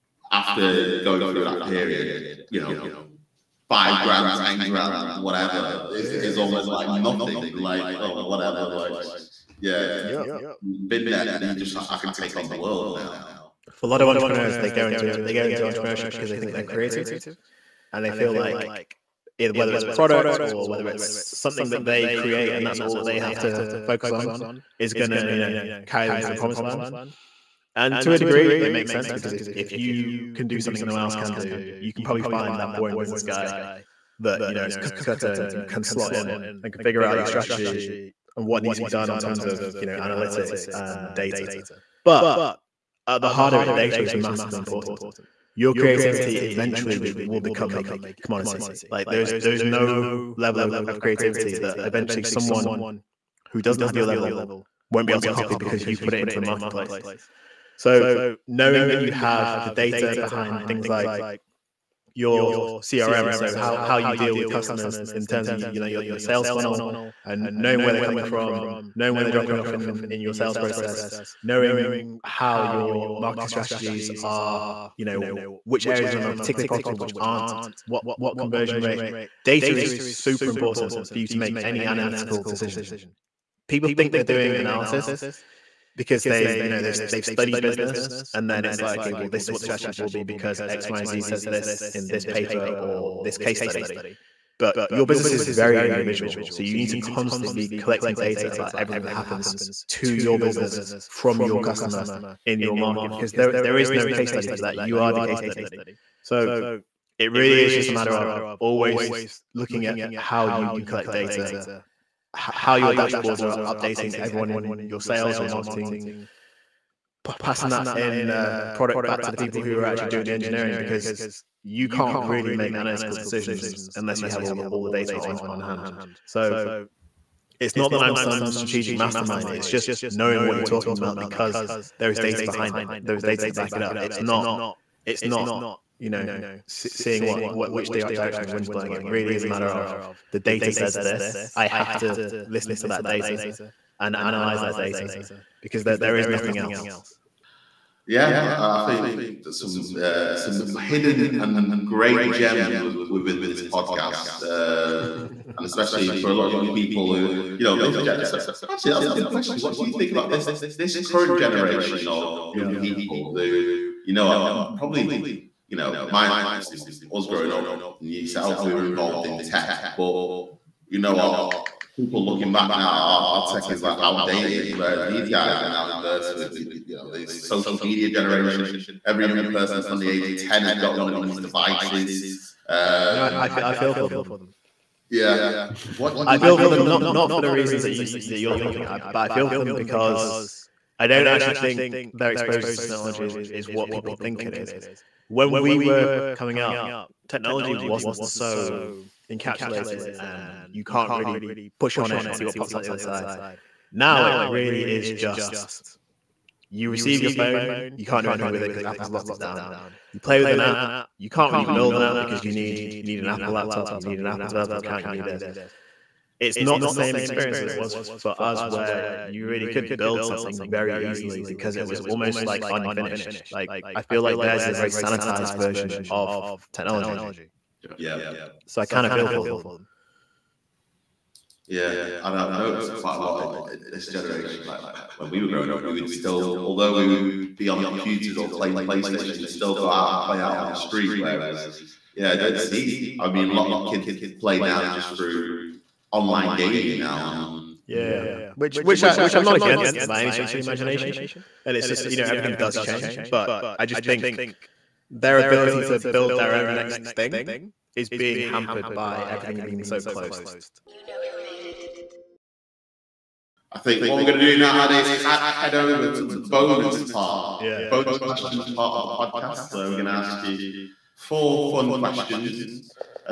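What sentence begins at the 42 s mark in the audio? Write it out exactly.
But at uh, the heart of it, data is massively important.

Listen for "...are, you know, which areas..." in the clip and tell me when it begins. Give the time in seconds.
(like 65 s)
74 s.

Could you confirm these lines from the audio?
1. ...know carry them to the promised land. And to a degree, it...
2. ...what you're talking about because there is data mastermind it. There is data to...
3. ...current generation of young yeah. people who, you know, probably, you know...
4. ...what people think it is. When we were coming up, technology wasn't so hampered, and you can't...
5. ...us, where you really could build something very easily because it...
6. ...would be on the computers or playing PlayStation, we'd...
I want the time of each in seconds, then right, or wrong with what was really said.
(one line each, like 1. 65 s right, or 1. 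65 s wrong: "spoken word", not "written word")
1. 25 s right
2. 130 s wrong: "behind", not "mastermind"
3. 161 s right
4. 193 s wrong: "encapsulated", not "hampered"
5. 218 s right
6. 237 s right.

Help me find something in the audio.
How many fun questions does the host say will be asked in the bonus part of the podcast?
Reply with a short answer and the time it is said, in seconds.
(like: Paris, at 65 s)
4, at 271 s.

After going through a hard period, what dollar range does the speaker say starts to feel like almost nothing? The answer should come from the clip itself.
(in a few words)
5,000 to 10,000.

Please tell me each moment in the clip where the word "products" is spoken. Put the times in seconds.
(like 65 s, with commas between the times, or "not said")
19 s, 118 s.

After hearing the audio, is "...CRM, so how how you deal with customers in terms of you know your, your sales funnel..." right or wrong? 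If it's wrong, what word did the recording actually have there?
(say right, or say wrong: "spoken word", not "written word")
right.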